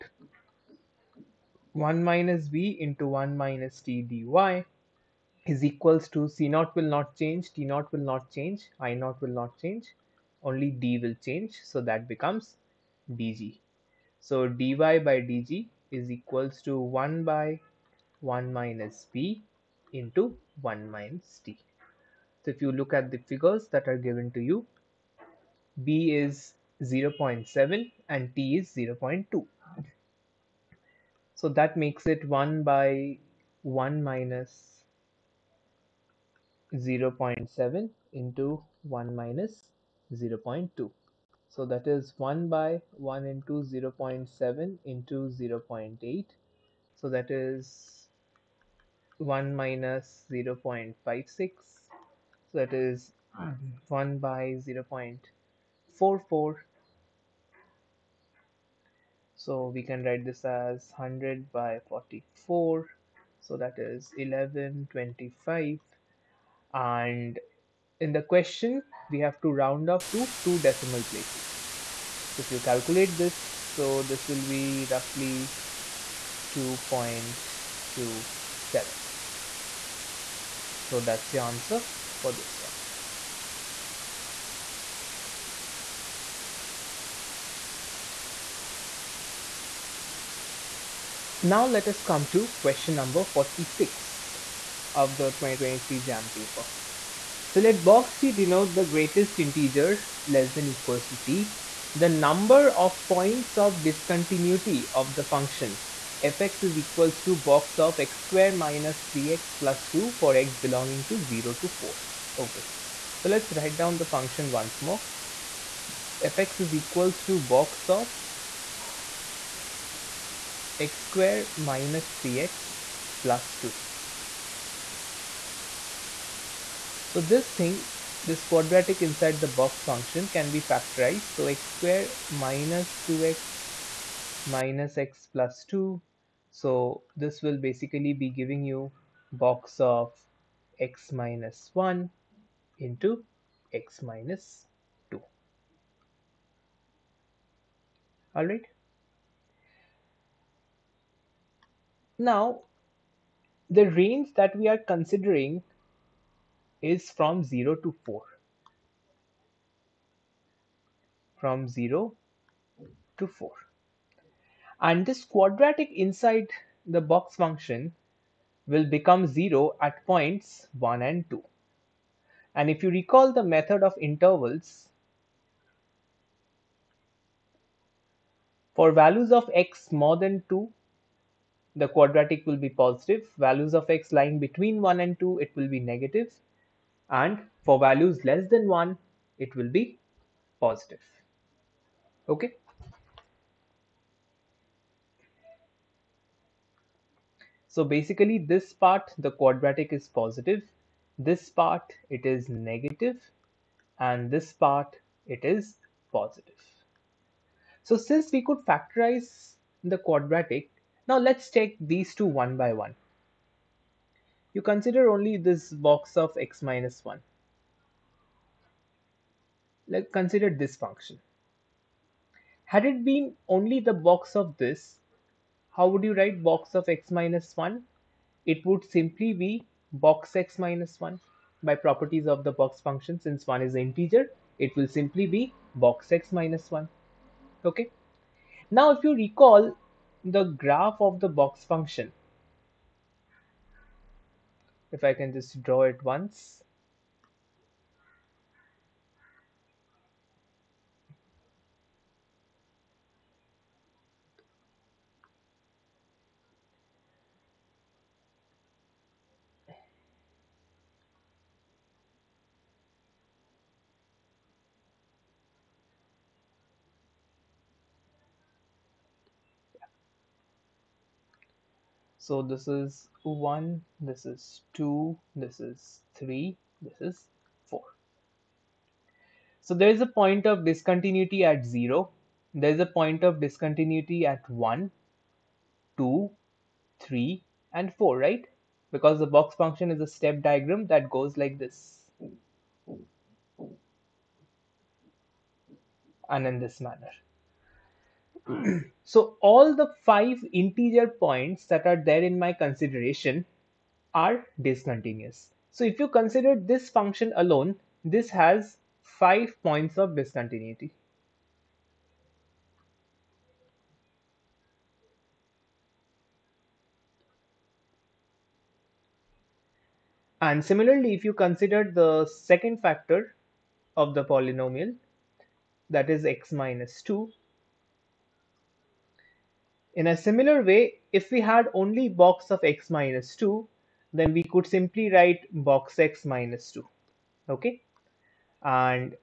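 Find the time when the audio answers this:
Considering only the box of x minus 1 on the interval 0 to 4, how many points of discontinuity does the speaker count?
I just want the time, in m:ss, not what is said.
5:09.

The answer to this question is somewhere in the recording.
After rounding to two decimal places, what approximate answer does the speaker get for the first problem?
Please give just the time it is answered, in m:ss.
1:16.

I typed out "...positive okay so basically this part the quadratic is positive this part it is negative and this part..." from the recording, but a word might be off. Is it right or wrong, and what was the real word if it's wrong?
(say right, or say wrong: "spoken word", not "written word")
right.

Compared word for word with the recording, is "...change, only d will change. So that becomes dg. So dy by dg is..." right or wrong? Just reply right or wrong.
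right.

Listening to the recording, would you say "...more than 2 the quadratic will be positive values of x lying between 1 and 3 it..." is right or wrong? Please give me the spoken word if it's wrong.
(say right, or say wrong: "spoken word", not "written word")
wrong: "2", not "3".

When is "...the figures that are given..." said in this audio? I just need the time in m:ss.
0:23.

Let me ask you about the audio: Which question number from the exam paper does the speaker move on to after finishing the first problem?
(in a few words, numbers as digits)
46.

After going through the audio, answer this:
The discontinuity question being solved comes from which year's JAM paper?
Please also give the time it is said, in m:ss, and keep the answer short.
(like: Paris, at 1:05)
2023, at 1:35.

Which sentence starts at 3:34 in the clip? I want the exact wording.
You consider only this box of x minus 1.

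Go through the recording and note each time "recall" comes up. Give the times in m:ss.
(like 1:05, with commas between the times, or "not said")
2:52, 3:59.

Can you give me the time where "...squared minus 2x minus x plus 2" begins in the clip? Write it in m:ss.
2:11.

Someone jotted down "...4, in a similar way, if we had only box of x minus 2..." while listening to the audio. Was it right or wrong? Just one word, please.
wrong.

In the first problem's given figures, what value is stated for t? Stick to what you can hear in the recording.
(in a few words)
0.2.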